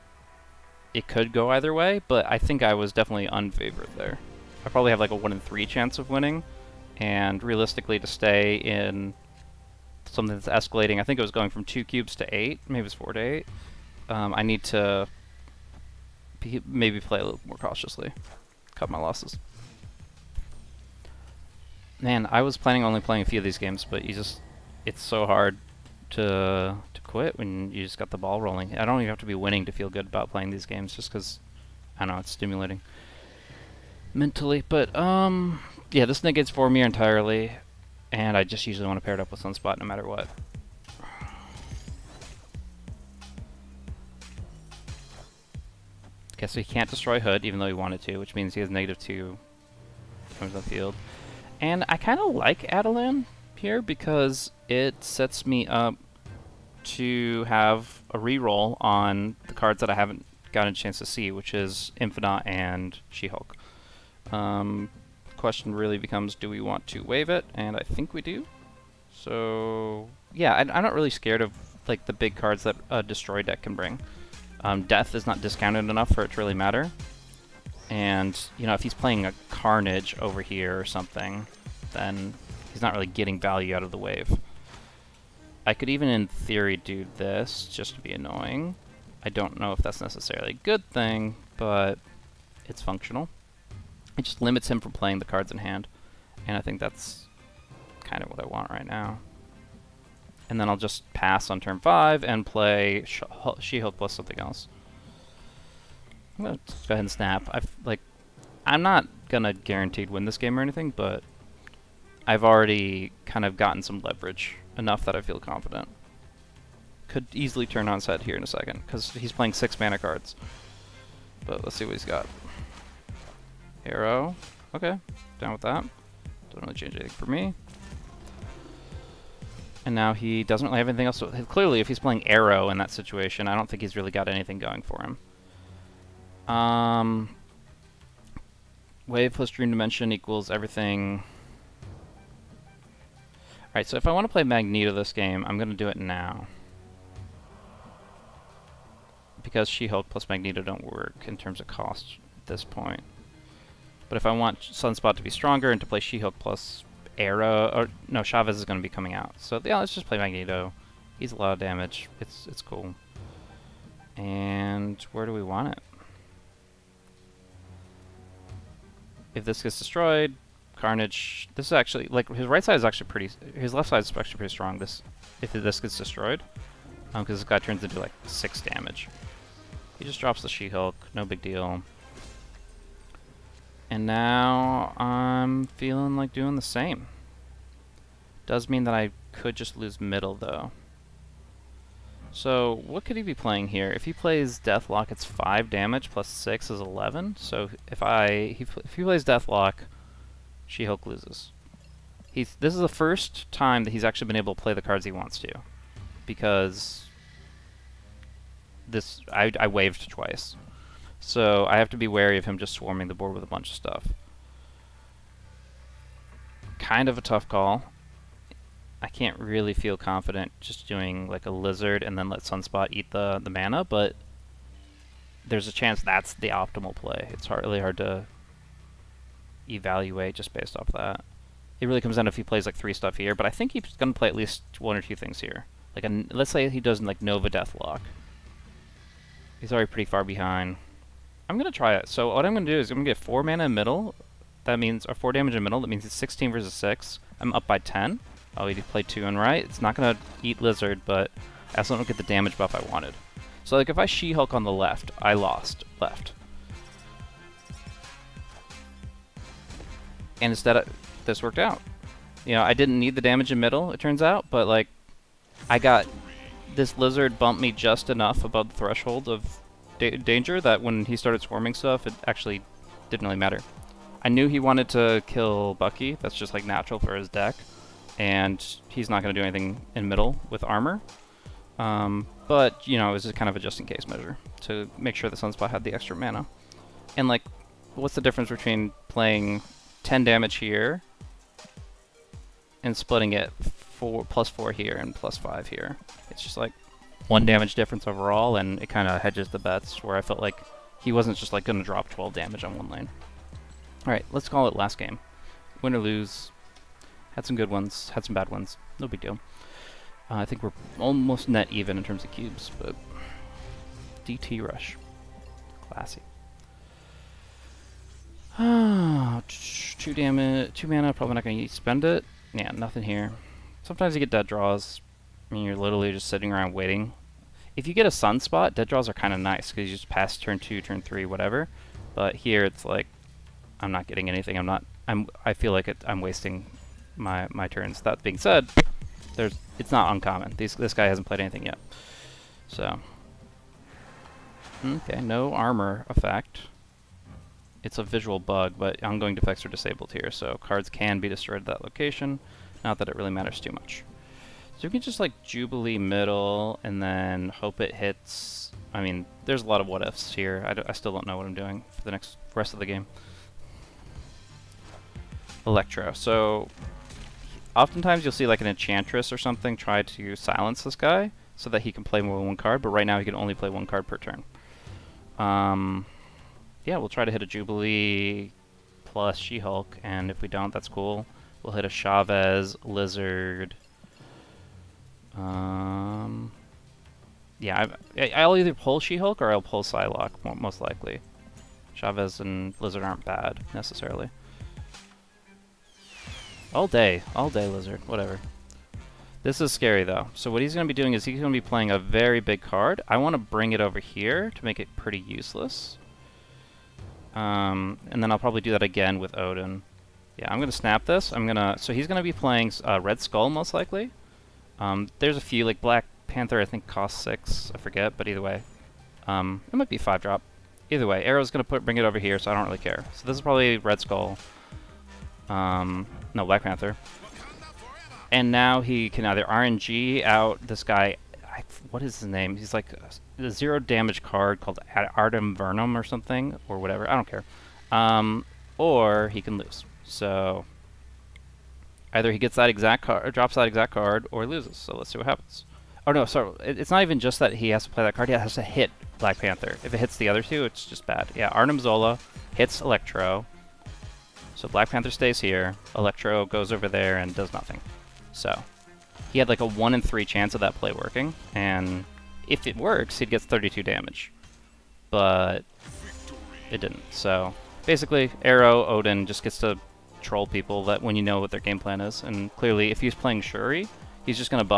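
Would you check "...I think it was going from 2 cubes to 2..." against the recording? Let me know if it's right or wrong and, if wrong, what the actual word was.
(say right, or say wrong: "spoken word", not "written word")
wrong: "8", not "2".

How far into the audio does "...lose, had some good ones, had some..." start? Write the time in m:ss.
5:05.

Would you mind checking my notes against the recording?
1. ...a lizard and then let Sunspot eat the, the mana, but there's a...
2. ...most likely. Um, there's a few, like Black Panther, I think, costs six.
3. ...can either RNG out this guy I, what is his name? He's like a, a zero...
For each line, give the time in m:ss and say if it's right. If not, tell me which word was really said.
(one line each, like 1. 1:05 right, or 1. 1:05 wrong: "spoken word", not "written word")
1. 3:41 right
2. 6:53 right
3. 7:09 right.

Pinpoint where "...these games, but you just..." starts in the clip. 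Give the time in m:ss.
0:23.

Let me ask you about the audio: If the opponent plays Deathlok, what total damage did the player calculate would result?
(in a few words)
11.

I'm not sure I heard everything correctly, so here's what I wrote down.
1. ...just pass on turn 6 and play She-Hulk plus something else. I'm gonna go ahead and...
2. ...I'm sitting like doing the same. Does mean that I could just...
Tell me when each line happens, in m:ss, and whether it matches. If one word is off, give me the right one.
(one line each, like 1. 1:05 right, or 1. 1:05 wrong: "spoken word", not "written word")
1. 1:40 wrong: "5", not "6"
2. 3:04 wrong: "feeling", not "sitting".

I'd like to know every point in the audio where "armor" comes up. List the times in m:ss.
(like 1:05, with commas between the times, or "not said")
4:40, 5:45.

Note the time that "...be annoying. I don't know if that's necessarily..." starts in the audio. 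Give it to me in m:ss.
1:28.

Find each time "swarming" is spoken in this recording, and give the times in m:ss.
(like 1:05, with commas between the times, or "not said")
3:32, 4:31.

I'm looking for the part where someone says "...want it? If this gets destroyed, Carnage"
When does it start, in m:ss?
2:45.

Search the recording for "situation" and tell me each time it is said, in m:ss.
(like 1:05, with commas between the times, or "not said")
2:12.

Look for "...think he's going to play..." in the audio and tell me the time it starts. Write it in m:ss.
3:53.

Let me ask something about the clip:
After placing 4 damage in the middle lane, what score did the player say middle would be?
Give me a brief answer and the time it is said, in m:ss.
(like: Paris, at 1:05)
16 versus 6, at 4:06.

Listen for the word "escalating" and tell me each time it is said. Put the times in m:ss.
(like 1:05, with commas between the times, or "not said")
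0:10.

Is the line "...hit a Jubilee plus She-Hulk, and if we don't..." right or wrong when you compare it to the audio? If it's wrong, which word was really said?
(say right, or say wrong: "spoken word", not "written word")
right.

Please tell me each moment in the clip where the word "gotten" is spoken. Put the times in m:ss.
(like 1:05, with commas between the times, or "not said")
1:00, 1:53.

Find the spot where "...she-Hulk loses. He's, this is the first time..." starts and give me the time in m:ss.
3:20.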